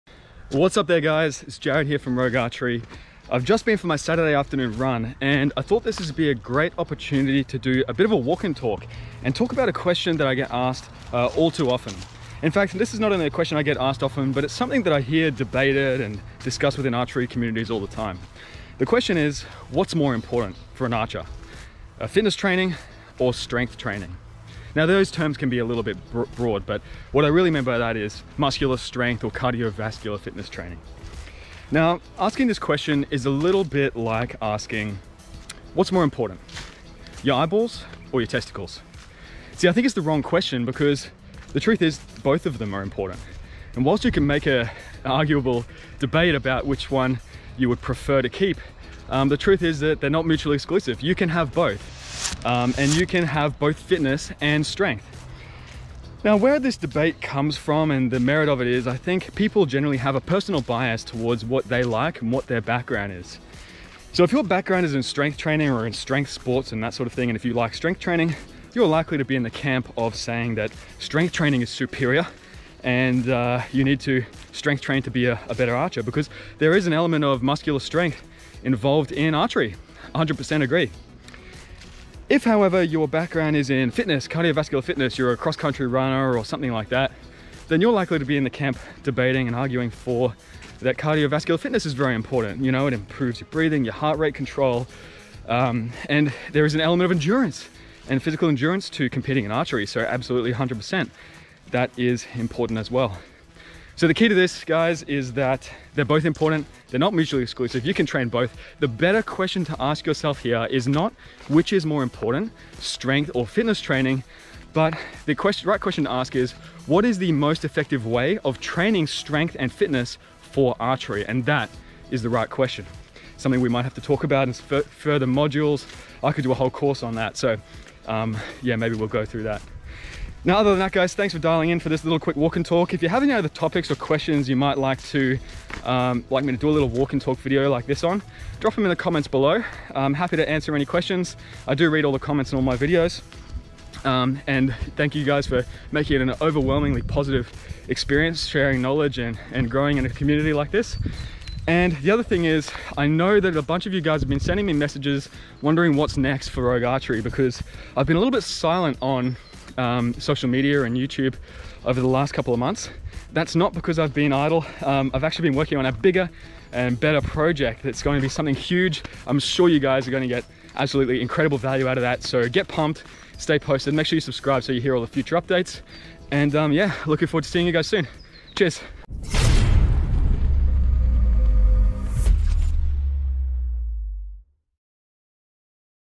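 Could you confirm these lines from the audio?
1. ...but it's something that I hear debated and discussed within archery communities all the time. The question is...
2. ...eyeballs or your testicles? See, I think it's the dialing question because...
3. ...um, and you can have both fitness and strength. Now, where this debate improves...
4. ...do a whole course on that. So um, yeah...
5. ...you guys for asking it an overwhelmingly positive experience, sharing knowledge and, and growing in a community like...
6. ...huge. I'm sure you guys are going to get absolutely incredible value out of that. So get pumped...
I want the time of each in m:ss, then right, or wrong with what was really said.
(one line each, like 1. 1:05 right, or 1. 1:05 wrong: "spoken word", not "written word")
1. 0:14 right
2. 0:37 wrong: "wrong", not "dialing"
3. 0:52 wrong: "comes", not "improves"
4. 2:06 right
5. 2:25 wrong: "making", not "asking"
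6. 2:48 right.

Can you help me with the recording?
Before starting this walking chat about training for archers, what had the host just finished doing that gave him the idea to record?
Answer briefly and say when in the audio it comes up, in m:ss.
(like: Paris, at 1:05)
Saturday afternoon run, at 0:03.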